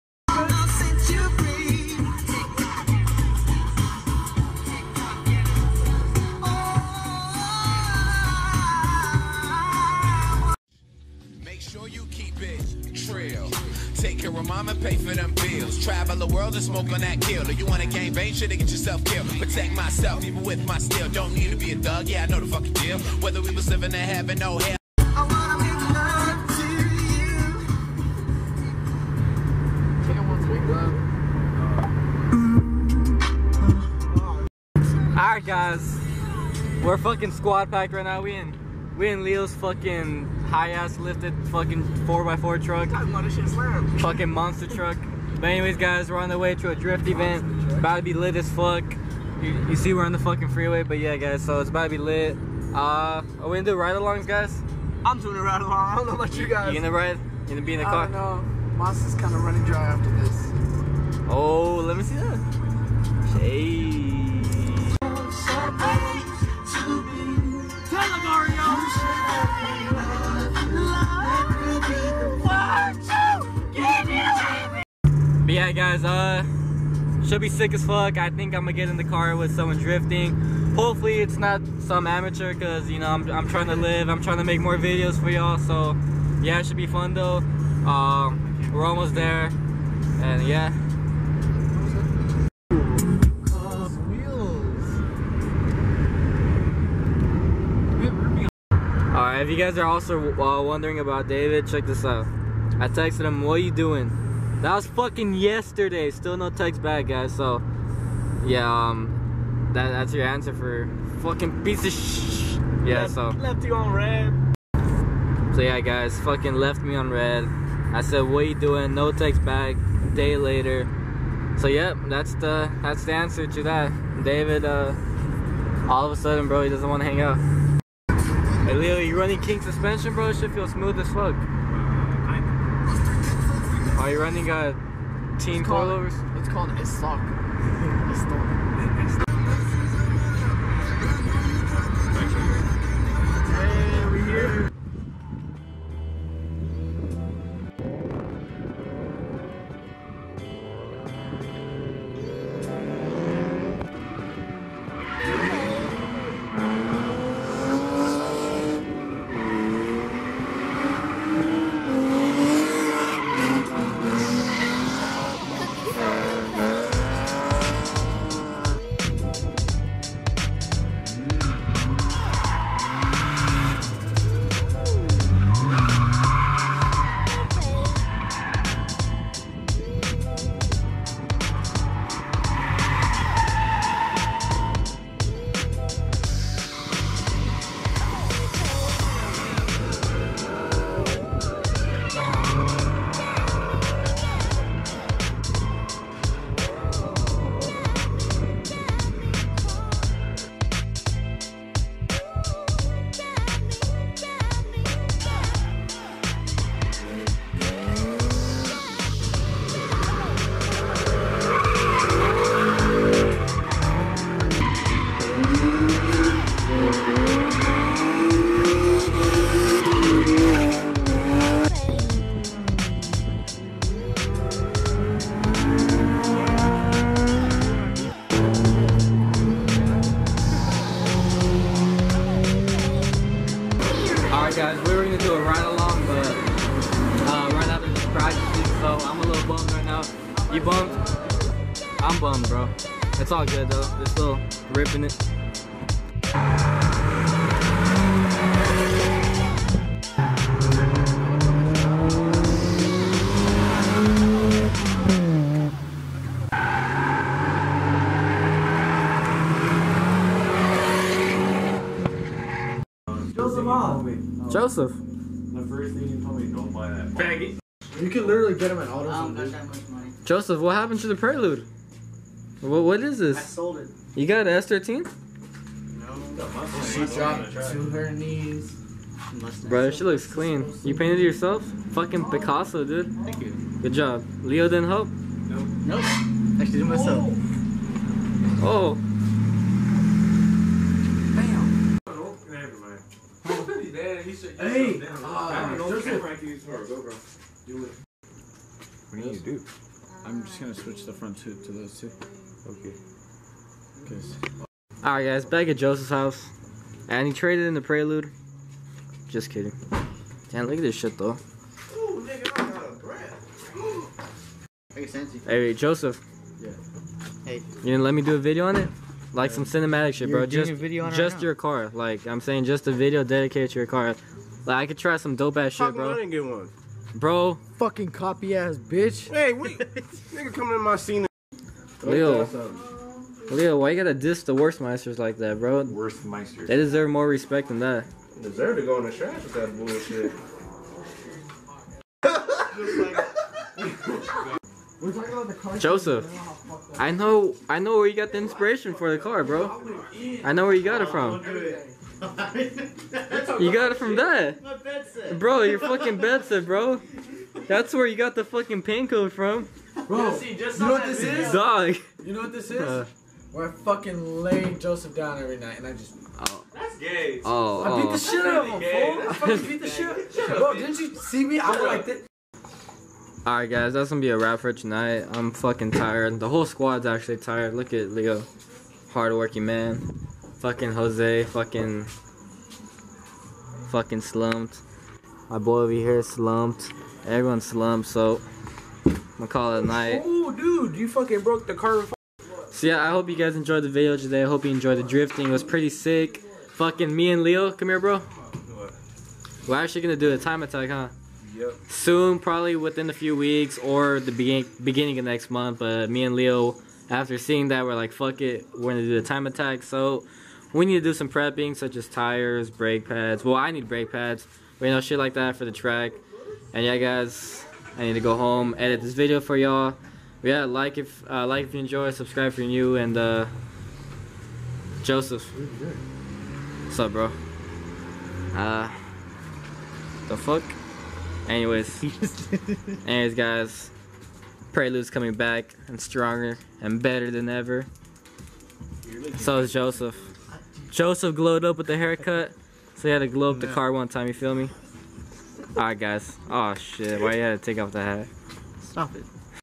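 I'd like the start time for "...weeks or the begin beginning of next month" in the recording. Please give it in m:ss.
6:43.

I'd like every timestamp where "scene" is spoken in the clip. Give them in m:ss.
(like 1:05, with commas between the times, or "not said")
5:30.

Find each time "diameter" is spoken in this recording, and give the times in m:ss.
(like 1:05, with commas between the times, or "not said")
not said.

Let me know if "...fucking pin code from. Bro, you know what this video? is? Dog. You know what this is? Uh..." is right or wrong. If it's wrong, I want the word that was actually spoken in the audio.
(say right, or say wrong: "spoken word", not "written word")
right.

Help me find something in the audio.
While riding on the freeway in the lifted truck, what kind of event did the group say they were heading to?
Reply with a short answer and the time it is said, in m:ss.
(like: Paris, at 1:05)
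drift event, at 0:46.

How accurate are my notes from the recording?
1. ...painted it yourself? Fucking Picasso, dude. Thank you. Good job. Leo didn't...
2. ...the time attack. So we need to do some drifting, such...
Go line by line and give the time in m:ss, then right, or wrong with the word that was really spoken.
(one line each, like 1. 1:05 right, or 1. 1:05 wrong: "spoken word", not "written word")
1. 4:40 right
2. 6:49 wrong: "prepping", not "drifting".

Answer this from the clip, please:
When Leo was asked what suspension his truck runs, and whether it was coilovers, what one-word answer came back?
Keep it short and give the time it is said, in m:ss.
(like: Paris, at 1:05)
Stock, at 2:16.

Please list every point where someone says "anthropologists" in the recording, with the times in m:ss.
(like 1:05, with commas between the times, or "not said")
not said.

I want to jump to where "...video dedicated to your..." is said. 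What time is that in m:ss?
5:22.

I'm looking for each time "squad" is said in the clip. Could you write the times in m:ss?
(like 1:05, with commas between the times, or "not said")
0:37, 6:16.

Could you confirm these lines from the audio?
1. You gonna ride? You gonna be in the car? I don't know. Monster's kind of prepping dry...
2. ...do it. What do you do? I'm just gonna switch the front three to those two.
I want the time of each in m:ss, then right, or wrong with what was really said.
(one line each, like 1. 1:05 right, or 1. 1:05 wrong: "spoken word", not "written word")
1. 0:56 wrong: "running", not "prepping"
2. 4:57 wrong: "two", not "three".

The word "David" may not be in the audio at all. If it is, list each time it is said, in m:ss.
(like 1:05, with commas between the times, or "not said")
1:41, 2:04.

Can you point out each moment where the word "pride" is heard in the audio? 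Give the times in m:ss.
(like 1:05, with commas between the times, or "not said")
not said.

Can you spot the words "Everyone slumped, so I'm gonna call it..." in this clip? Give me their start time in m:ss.
6:27.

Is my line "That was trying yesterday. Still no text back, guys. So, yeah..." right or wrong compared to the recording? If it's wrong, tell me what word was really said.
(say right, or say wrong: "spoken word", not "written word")
wrong: "fucking", not "trying".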